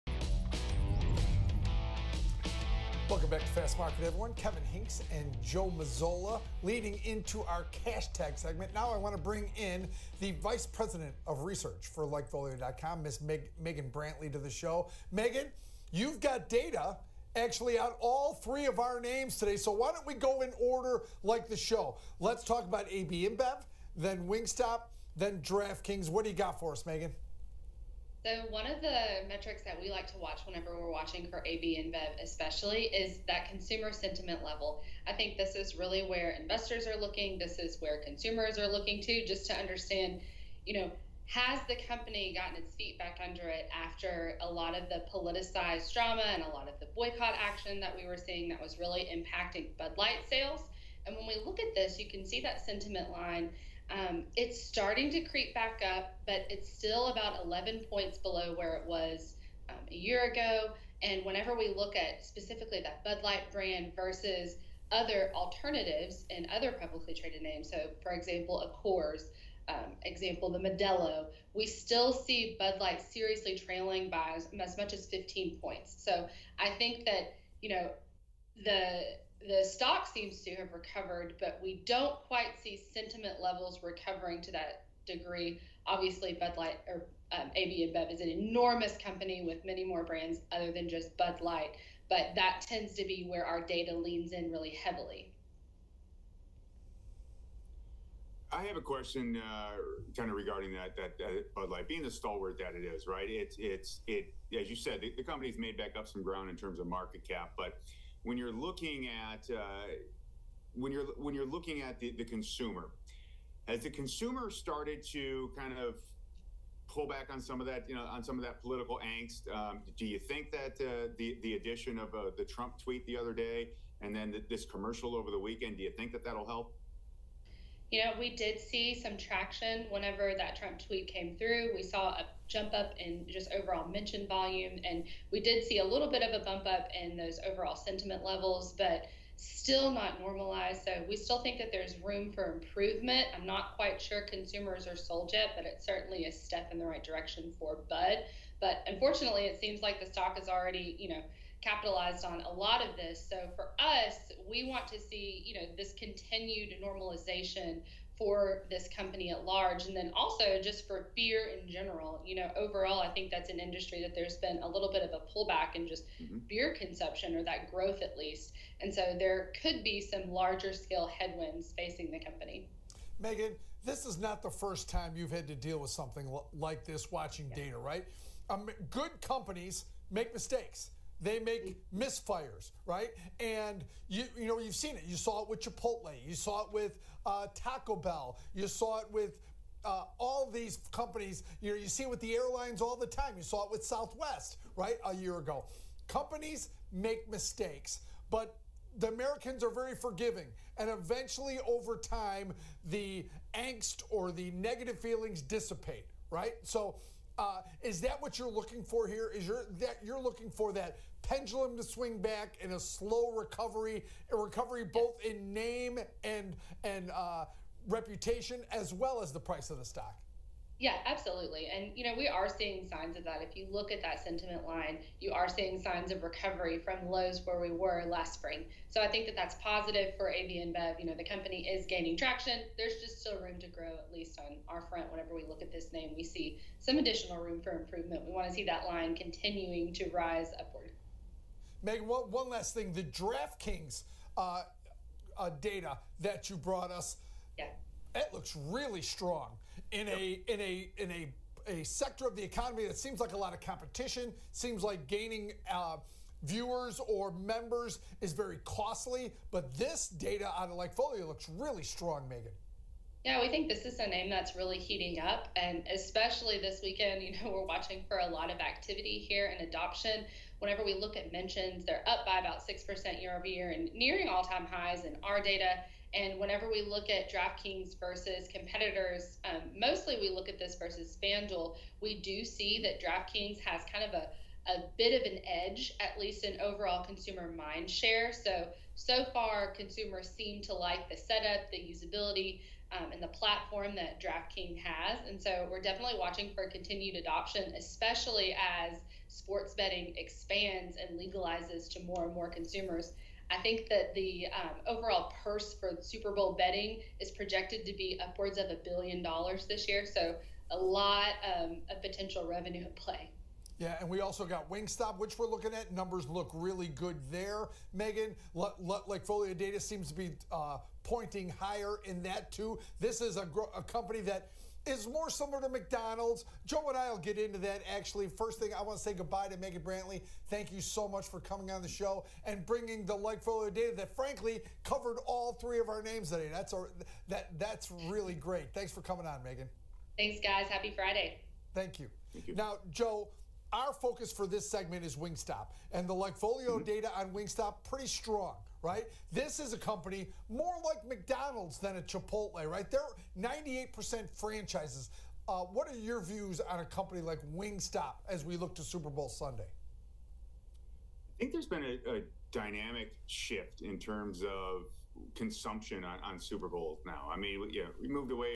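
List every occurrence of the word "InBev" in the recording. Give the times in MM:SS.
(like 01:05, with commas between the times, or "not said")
00:23, 00:31, 01:27, 03:50.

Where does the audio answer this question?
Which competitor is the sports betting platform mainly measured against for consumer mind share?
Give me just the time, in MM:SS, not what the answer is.
04:41.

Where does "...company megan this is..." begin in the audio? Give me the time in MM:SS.
02:52.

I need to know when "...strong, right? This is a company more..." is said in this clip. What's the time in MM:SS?
05:48.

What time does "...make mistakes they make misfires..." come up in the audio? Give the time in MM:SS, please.
03:00.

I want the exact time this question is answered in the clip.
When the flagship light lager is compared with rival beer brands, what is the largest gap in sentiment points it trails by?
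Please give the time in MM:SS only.
01:15.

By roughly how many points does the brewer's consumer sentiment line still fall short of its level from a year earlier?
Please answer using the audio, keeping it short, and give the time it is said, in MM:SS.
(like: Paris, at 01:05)
11, at 00:57.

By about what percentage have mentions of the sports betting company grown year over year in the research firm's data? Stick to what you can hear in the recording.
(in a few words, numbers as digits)
6%.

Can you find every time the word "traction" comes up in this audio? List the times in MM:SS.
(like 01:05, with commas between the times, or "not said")
02:09, 03:52.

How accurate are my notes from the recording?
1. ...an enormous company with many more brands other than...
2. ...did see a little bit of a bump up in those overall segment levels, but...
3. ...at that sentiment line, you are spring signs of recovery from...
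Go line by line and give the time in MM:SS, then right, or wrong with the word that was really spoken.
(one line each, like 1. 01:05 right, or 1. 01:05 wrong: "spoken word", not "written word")
1. 01:28 right
2. 02:15 wrong: "sentiment", not "segment"
3. 03:43 wrong: "seeing", not "spring".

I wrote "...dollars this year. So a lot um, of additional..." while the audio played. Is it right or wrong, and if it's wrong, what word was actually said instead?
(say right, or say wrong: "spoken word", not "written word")
wrong: "potential", not "additional".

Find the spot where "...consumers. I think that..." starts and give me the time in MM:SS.
05:02.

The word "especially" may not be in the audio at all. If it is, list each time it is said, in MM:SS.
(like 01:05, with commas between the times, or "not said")
00:32, 04:25, 04:57.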